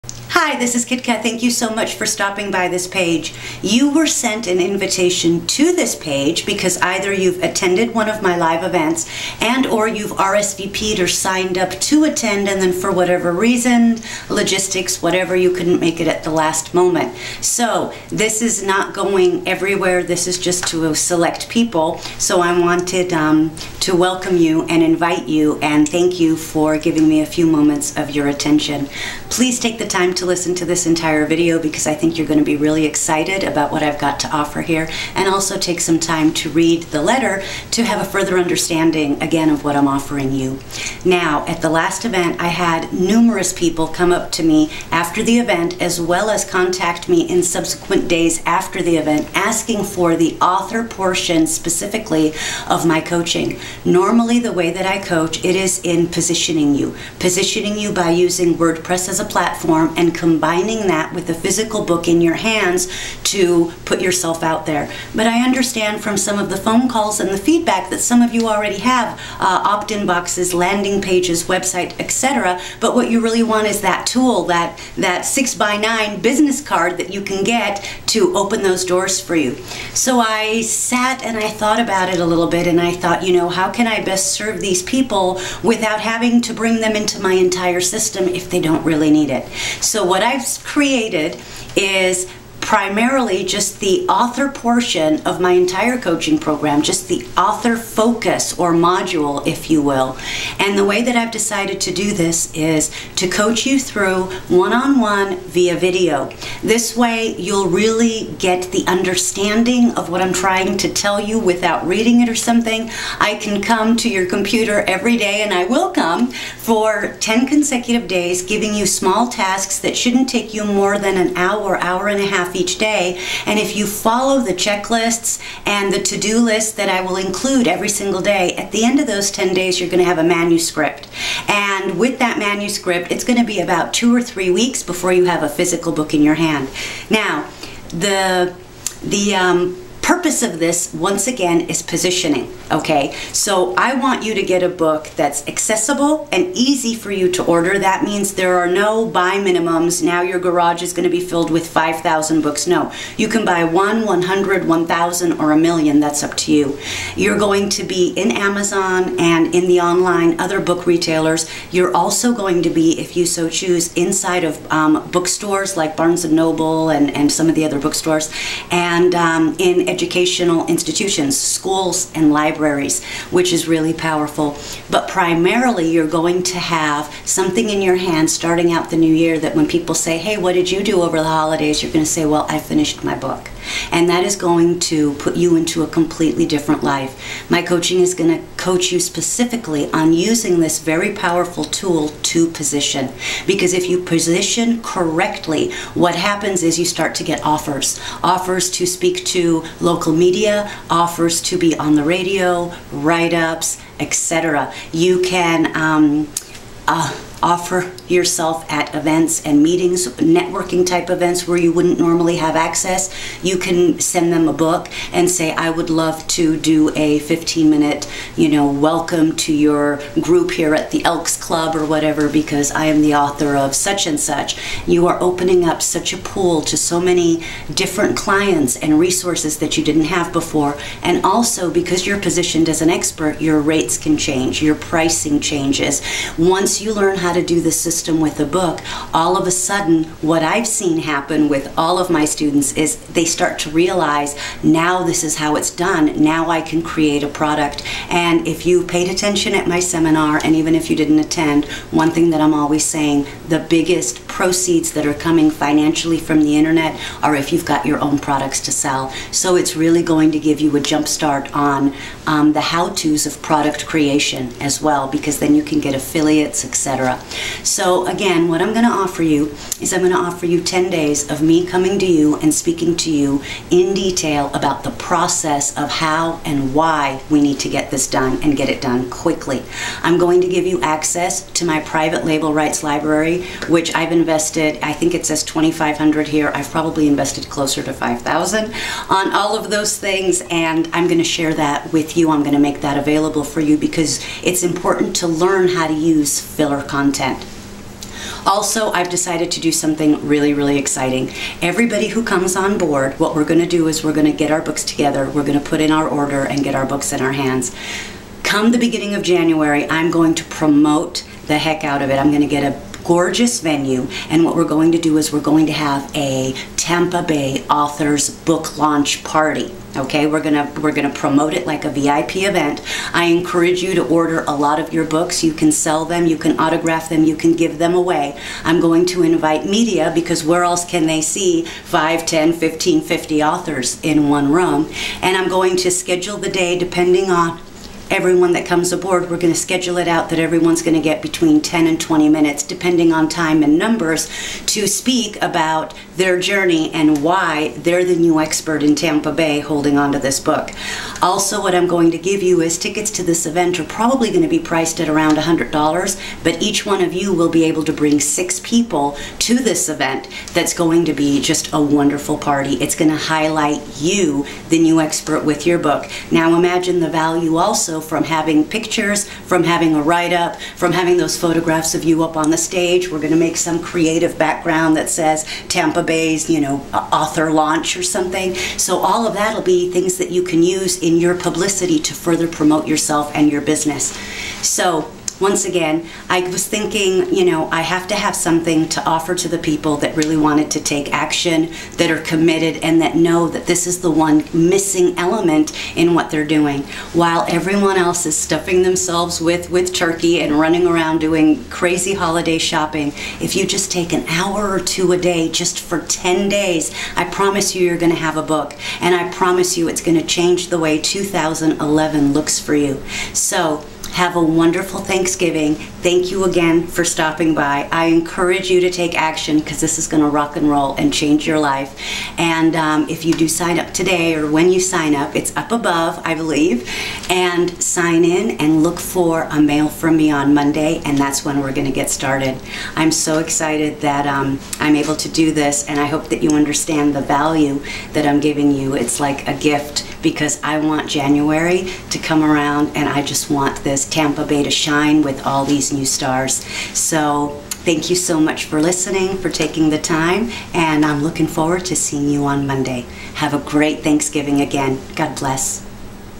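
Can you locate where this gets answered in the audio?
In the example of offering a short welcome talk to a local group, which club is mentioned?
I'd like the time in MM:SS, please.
03:41.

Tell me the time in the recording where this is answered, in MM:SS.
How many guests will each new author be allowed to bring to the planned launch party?
05:58.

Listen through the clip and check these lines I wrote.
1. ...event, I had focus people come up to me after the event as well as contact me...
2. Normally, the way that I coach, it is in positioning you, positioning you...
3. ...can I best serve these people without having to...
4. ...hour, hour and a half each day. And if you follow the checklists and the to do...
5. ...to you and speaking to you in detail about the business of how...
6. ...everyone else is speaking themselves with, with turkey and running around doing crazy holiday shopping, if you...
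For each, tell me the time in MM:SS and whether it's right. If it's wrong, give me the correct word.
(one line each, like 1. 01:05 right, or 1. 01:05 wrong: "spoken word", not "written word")
1. 00:42 wrong: "numerous", not "focus"
2. 00:53 right
3. 01:23 right
4. 02:01 right
5. 04:31 wrong: "process", not "business"
6. 06:37 wrong: "stuffing", not "speaking".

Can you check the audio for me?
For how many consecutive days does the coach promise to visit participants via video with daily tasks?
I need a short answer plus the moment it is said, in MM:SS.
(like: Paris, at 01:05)
10, at 01:57.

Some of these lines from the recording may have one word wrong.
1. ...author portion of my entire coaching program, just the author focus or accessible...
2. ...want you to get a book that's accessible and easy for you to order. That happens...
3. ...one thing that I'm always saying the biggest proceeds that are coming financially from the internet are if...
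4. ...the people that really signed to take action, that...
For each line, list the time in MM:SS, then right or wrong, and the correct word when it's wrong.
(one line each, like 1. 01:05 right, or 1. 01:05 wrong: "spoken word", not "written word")
1. 01:34 wrong: "module", not "accessible"
2. 02:23 wrong: "means", not "happens"
3. 04:11 right
4. 06:29 wrong: "wanted", not "signed".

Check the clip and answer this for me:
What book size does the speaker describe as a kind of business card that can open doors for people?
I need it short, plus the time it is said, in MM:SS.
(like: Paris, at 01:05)
6 by 9, at 01:15.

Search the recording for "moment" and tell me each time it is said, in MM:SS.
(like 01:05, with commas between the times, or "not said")
00:16, 00:27.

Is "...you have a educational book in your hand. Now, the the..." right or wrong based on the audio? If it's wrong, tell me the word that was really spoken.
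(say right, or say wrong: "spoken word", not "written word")
wrong: "physical", not "educational".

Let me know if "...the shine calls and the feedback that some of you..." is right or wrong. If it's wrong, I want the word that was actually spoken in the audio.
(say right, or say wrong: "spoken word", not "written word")
wrong: "phone", not "shine".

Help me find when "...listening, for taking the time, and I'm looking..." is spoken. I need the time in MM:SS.
07:28.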